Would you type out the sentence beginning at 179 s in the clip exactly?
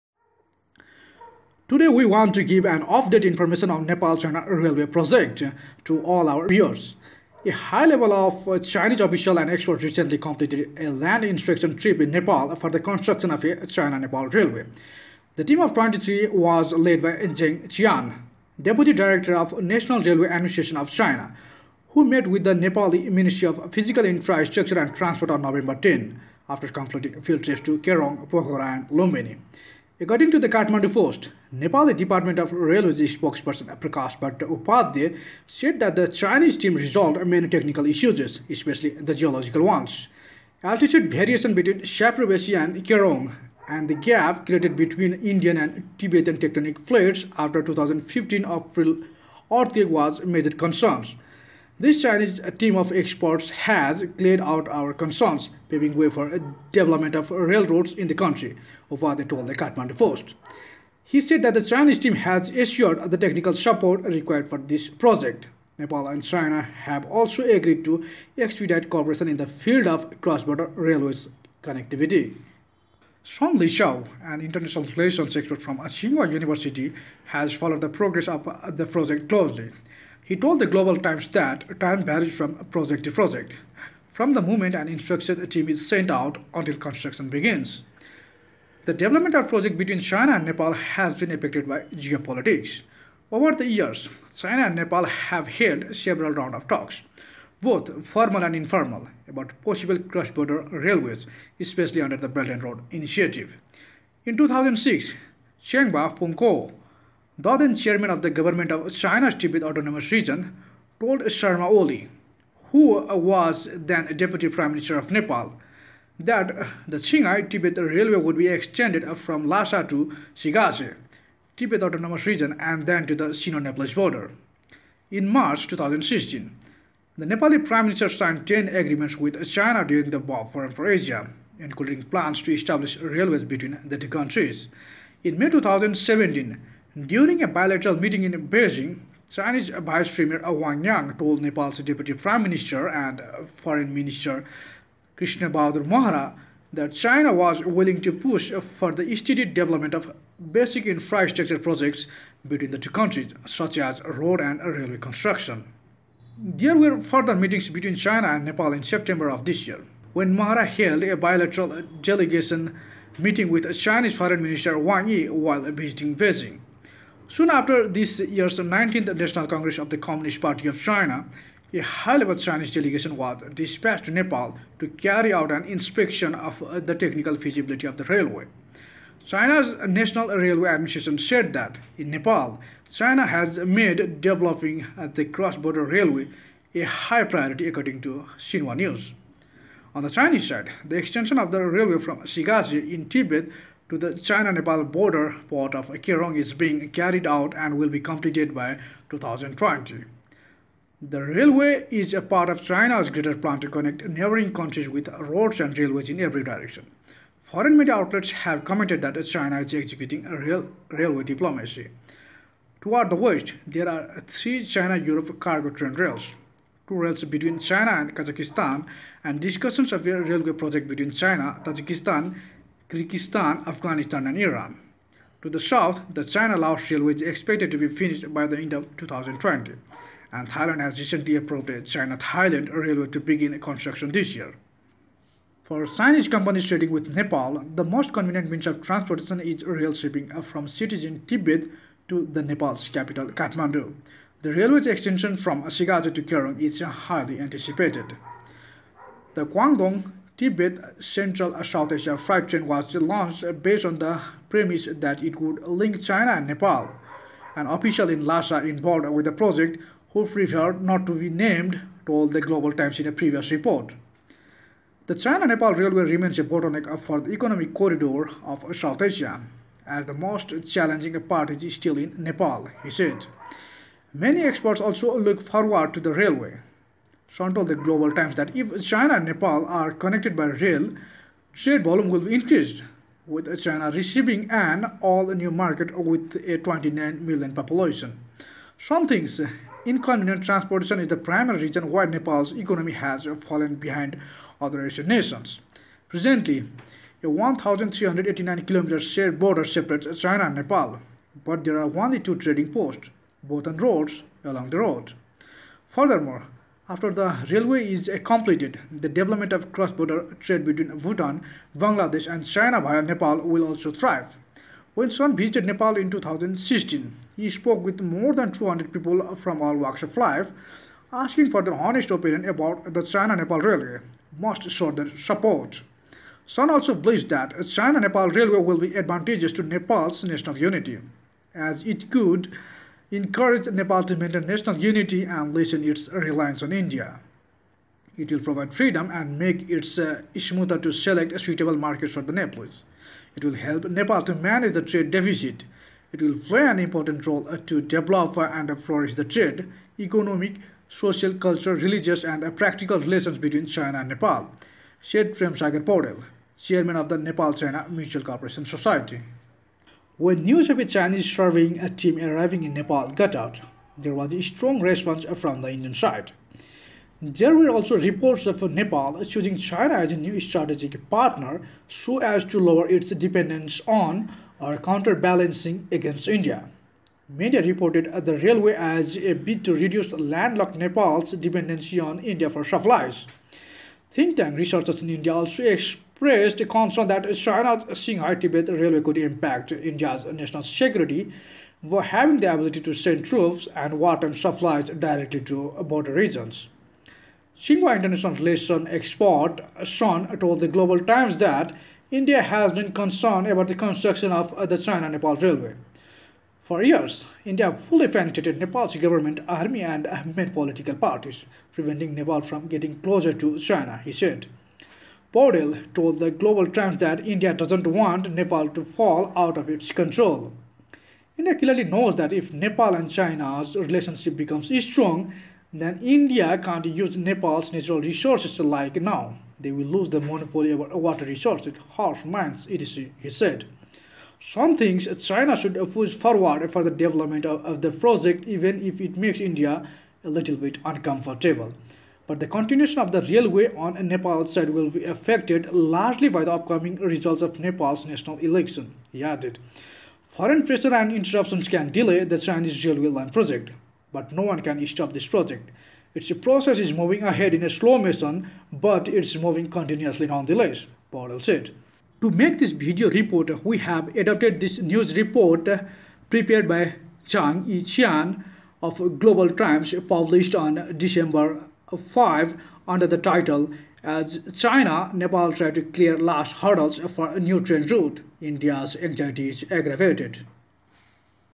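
China's National Railway Administration said that in Nepal, China has made developing the cross-border railway a high priority according to Xinhua News.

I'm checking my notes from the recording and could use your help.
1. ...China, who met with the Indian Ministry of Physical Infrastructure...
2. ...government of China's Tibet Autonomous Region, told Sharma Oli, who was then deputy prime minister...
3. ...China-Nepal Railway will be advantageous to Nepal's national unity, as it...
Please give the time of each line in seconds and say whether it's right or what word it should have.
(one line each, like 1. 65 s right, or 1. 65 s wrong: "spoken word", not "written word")
1. 20 s wrong: "Nepali", not "Indian"
2. 108 s right
3. 327 s right.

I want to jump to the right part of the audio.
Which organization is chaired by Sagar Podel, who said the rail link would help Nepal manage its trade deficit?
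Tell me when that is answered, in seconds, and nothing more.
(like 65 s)
357 s.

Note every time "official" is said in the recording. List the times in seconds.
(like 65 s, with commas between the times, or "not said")
8 s, 257 s.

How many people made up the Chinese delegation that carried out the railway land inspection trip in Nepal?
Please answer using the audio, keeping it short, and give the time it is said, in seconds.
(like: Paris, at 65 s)
23, at 15 s.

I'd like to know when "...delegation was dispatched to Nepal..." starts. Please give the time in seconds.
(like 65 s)
172 s.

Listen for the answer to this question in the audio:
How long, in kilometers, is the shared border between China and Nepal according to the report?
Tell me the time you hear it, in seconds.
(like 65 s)
297 s.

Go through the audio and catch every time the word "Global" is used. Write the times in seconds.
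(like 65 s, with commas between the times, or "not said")
80 s, 262 s, 277 s, 400 s, 416 s, 469 s.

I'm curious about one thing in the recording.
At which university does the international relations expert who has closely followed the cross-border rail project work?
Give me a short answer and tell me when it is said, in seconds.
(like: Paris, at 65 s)
Tsinghua University, at 75 s.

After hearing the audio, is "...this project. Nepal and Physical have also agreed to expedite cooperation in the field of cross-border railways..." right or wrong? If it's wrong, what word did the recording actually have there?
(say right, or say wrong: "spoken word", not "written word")
wrong: "China", not "Physical".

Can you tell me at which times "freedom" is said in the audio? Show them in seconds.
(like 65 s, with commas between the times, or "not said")
338 s.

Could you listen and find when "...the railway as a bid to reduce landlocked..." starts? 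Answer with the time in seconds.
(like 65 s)
378 s.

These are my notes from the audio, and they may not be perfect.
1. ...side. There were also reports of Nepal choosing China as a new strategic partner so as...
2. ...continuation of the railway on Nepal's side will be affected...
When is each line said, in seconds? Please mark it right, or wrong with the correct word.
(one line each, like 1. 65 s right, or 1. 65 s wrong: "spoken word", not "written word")
1. 365 s right
2. 442 s right.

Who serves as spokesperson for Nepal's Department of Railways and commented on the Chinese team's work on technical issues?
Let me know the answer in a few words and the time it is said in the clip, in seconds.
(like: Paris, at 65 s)
Prakash Bhatt Upadhyay, at 33 s.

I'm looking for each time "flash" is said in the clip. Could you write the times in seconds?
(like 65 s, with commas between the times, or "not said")
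not said.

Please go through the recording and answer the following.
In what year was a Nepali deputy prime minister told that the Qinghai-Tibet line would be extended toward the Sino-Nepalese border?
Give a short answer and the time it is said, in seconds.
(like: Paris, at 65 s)
2006, at 104 s.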